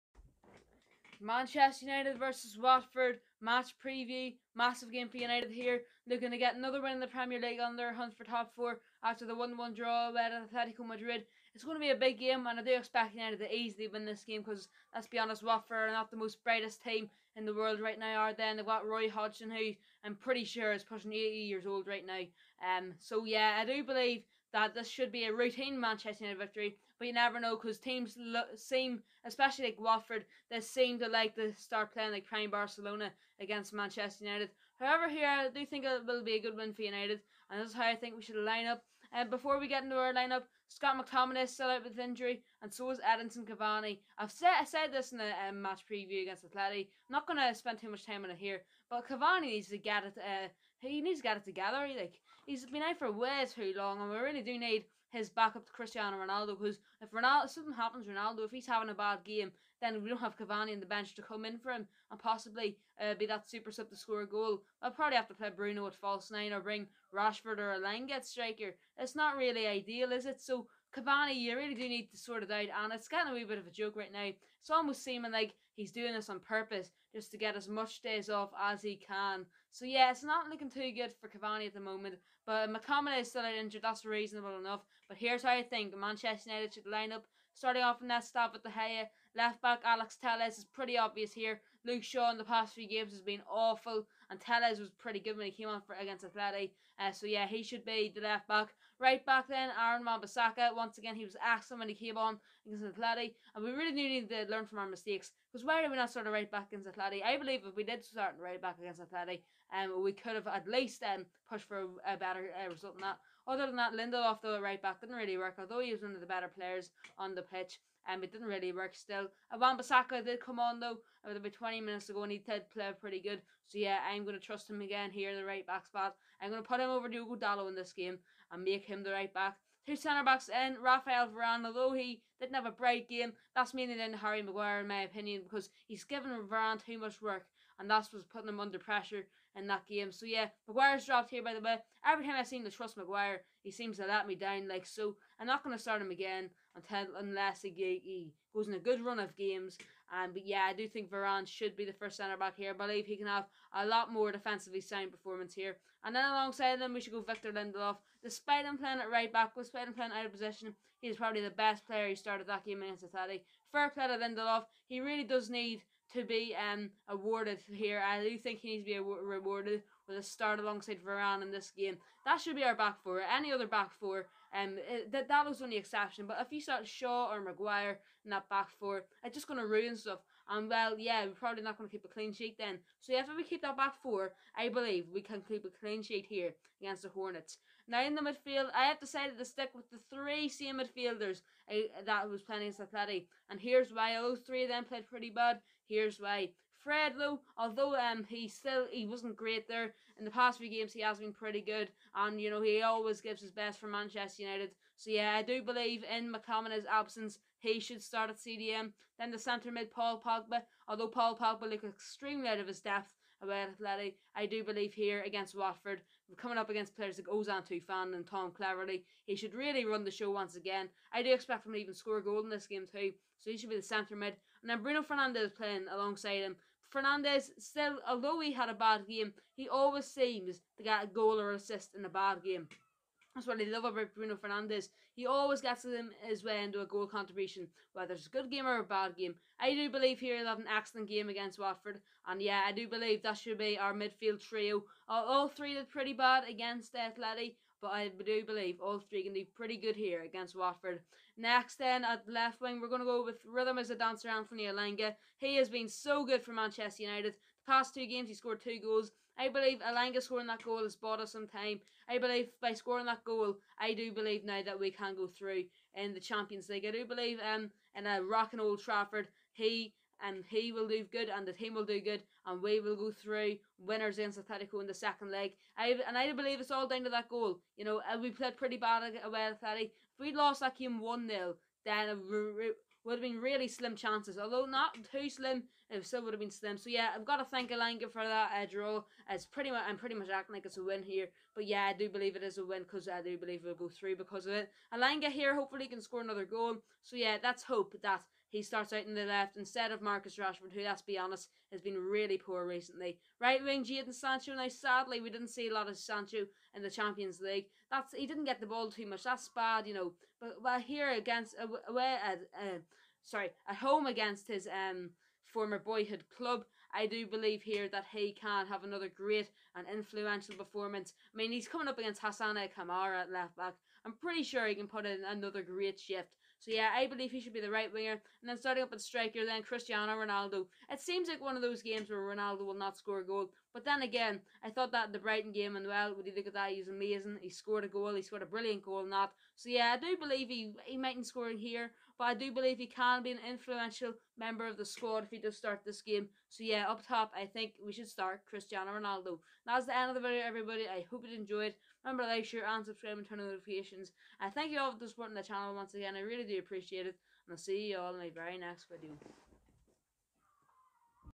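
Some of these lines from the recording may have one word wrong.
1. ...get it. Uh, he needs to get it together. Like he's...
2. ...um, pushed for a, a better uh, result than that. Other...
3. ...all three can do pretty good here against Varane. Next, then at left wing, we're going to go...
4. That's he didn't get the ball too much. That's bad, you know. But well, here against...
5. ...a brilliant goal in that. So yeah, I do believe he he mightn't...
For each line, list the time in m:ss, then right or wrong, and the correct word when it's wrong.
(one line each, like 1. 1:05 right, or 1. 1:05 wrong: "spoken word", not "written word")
1. 0:49 right
2. 1:51 right
3. 4:08 wrong: "Watford", not "Varane"
4. 5:07 right
5. 5:38 right.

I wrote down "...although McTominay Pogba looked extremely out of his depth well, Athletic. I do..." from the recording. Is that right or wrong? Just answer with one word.
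wrong.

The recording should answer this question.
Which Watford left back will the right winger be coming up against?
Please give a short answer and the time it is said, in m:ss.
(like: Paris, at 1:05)
Hassane Kamara, at 5:22.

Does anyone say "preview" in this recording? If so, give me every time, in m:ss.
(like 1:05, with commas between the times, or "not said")
0:03, 0:45.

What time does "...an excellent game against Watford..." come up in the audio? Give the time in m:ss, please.
4:00.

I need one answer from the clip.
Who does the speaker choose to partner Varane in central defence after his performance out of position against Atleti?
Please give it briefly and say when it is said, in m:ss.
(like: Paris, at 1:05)
Victor Lindelof, at 2:37.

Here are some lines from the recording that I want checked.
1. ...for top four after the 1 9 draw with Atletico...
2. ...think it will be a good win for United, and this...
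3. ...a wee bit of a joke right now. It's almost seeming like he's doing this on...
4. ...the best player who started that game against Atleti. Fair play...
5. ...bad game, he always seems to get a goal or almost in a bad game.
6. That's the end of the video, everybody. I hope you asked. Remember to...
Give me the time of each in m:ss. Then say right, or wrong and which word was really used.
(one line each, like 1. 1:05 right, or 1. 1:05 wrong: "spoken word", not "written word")
1. 0:08 wrong: "1", not "9"
2. 0:35 right
3. 1:13 right
4. 2:41 right
5. 3:48 wrong: "assist", not "almost"
6. 5:49 wrong: "enjoyed", not "asked".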